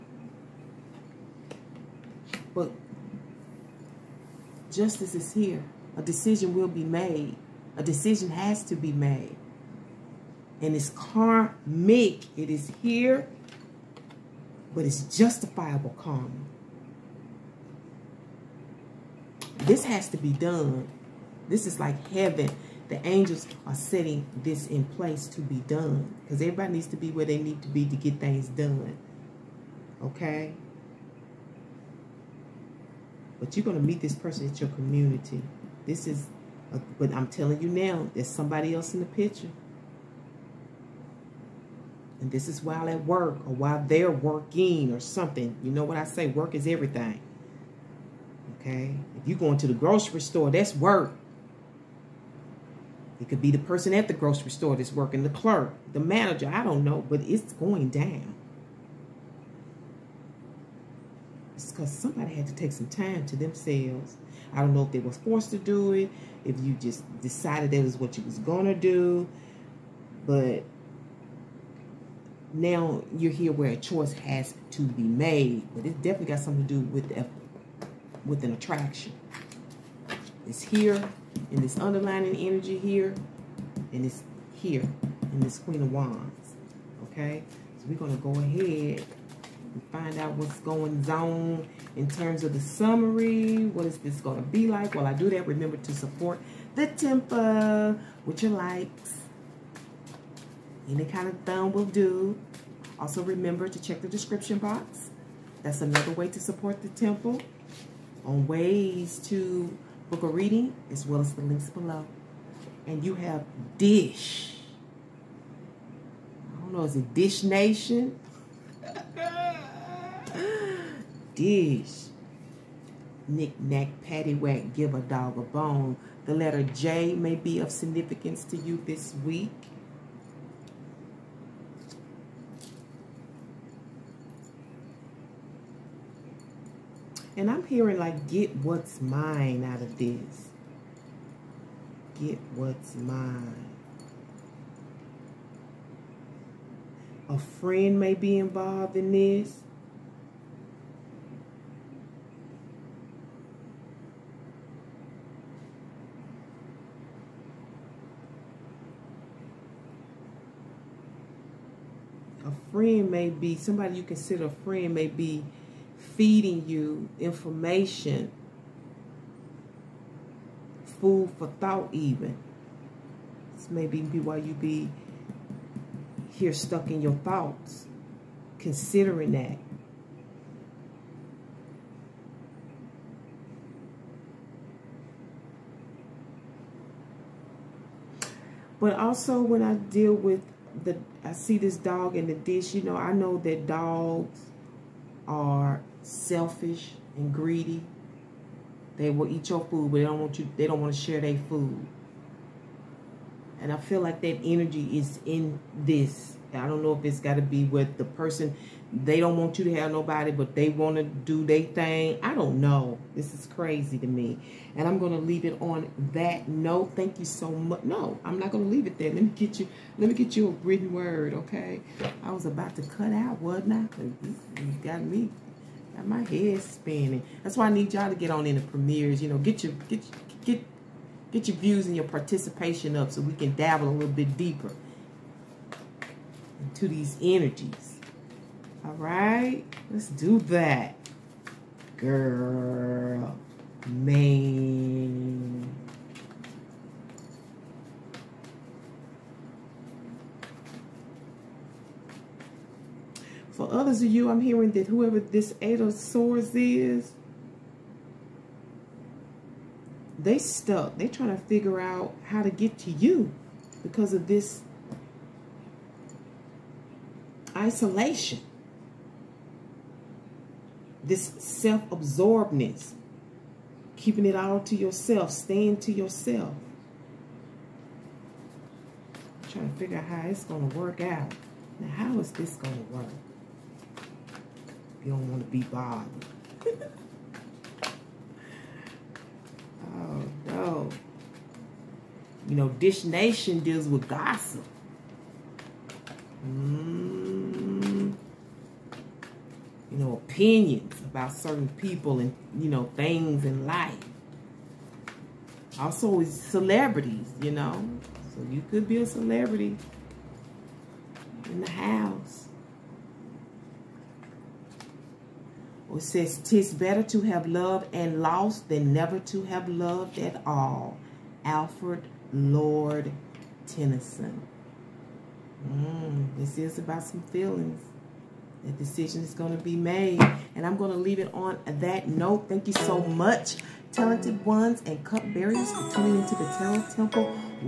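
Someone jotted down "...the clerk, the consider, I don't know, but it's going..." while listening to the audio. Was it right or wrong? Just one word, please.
wrong.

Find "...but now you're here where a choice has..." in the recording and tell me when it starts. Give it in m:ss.
1:10.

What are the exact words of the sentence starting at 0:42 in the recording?
And this is while at work or while they're working or something.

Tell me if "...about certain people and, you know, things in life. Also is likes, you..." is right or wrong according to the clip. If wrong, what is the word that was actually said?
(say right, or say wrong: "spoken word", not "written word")
wrong: "celebrities", not "likes".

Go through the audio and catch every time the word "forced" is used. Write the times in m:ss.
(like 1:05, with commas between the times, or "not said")
1:05.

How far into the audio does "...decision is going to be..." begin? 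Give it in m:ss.
5:28.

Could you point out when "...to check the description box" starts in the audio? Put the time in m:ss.
1:43.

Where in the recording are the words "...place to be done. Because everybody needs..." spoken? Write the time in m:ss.
0:24.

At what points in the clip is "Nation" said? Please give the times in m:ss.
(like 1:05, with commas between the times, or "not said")
1:57, 4:53.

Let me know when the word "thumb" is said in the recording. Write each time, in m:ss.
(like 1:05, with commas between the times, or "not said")
1:41.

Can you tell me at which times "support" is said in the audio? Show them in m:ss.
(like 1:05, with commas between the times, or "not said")
1:35, 1:46.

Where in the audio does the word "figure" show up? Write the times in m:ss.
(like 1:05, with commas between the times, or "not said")
4:21, 4:39.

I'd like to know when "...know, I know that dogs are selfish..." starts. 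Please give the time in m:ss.
3:12.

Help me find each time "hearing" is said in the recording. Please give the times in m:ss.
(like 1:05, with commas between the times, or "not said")
2:17, 4:14.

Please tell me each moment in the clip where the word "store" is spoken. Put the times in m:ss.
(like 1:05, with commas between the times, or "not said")
0:50, 0:54.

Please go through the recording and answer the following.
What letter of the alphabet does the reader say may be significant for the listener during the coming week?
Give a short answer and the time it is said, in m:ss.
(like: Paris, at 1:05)
J, at 2:06.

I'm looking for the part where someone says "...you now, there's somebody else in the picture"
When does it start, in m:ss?
0:37.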